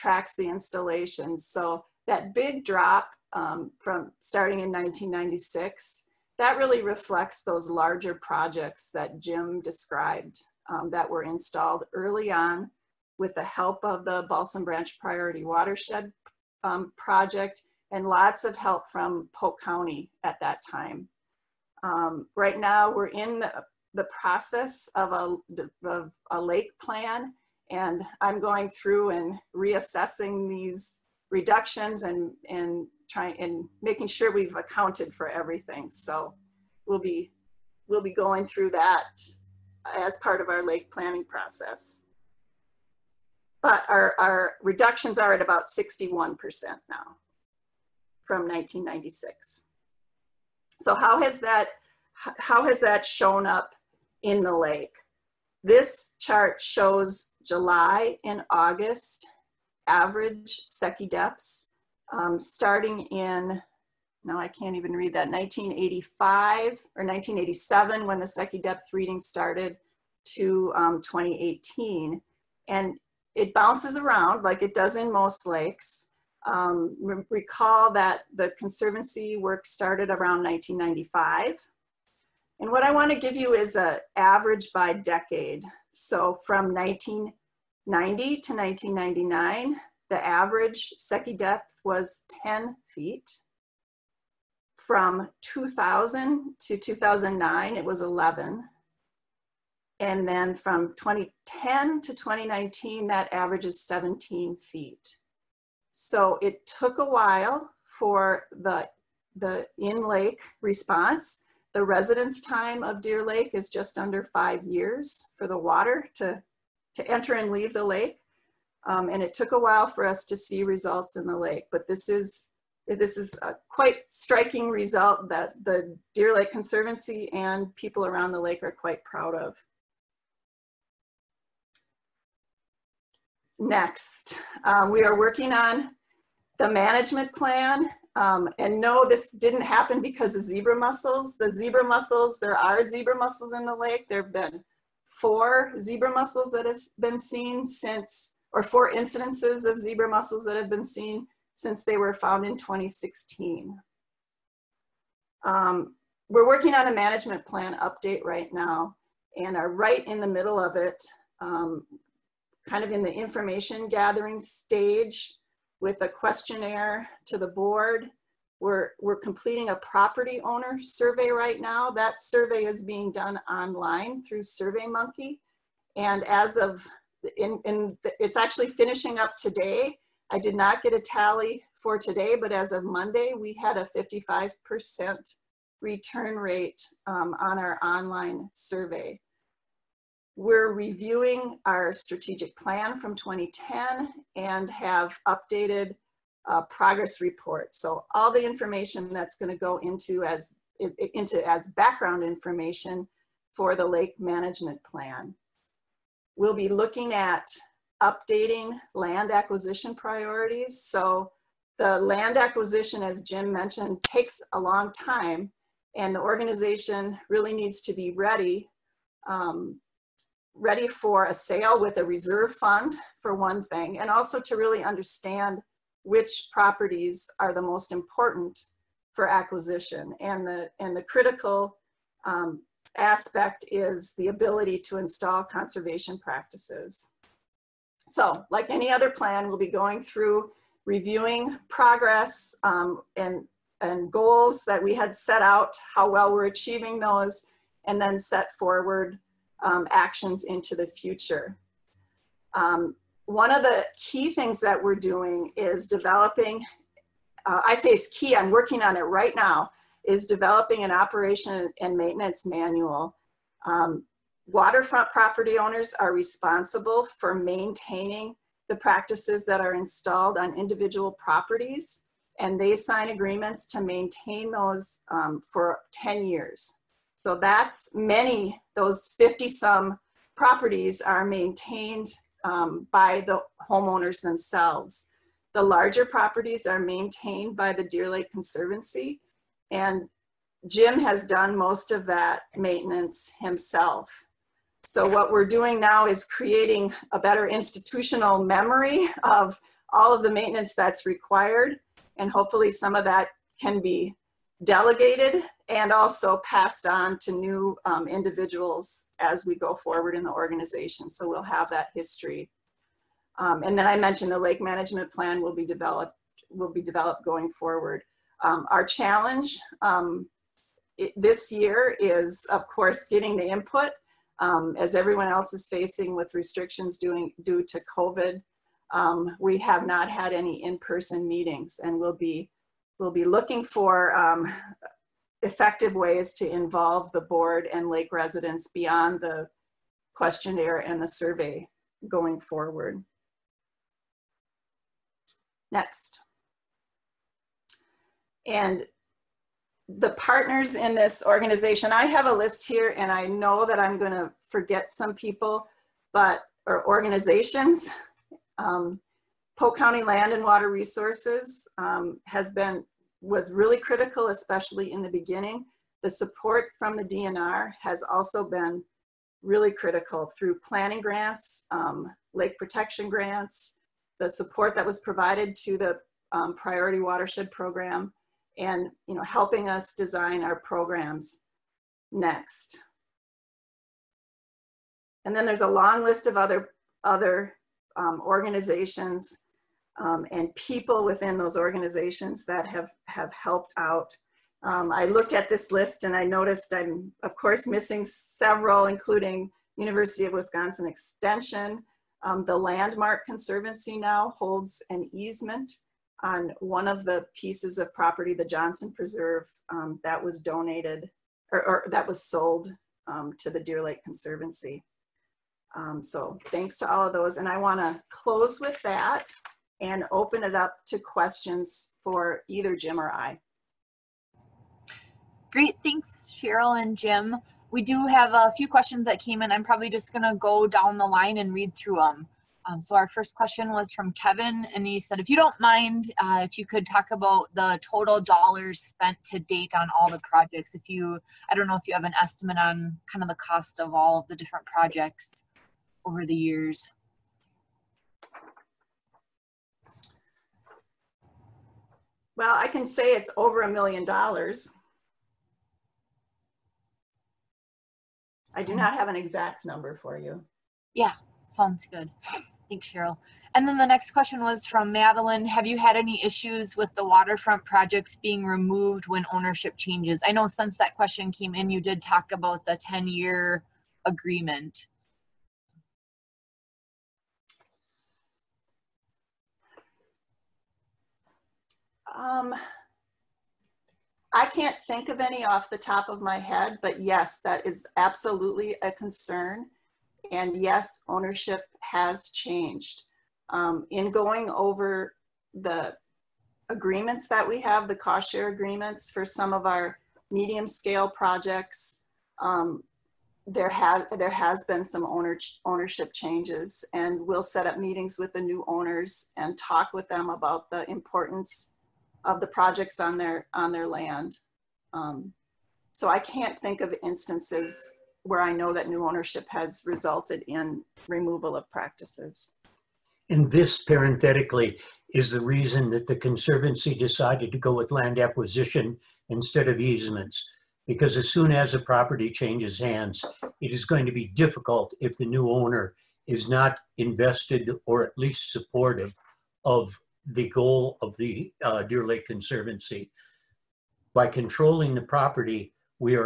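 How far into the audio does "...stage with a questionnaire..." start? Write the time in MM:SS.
02:44.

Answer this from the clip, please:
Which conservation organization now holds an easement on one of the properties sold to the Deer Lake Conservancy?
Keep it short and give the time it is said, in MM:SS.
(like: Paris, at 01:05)
Landmark Conservancy, at 06:42.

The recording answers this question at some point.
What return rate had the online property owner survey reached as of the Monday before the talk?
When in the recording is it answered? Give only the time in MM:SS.
03:03.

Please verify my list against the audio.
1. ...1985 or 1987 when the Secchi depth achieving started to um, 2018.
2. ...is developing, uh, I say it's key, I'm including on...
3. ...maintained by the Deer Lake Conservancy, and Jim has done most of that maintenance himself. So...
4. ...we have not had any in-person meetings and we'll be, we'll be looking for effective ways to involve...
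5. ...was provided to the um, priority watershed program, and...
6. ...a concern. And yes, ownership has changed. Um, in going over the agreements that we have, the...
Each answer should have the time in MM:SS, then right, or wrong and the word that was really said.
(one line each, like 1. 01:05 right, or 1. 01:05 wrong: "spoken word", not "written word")
1. 01:05 wrong: "reading", not "achieving"
2. 04:15 wrong: "working", not "including"
3. 04:46 right
4. 05:29 right
5. 06:14 right
6. 08:08 right.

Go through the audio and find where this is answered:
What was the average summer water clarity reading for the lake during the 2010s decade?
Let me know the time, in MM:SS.
01:43.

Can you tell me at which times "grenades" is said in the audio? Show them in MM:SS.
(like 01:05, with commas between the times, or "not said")
not said.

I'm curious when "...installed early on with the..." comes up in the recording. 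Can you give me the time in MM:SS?
00:11.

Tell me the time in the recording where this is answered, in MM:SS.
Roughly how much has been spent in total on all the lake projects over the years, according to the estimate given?
07:33.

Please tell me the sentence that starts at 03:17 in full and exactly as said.
So all the information that's going to go into as into as background information for the lake management plan.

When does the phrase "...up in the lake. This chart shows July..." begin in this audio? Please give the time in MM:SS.
00:53.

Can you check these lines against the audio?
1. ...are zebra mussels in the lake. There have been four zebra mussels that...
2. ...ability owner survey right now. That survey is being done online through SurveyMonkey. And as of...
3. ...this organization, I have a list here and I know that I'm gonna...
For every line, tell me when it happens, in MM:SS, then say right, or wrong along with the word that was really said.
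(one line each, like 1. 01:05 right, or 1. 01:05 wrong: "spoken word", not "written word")
1. 02:22 right
2. 02:49 wrong: "property", not "ability"
3. 05:50 right.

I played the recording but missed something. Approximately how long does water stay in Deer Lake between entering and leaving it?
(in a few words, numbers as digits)
just under 5 years.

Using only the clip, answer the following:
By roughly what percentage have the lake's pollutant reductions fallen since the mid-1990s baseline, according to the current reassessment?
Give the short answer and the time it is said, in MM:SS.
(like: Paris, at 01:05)
61%, at 00:45.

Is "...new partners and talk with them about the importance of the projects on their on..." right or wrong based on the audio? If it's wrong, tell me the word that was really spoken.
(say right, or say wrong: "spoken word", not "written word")
wrong: "owners", not "partners".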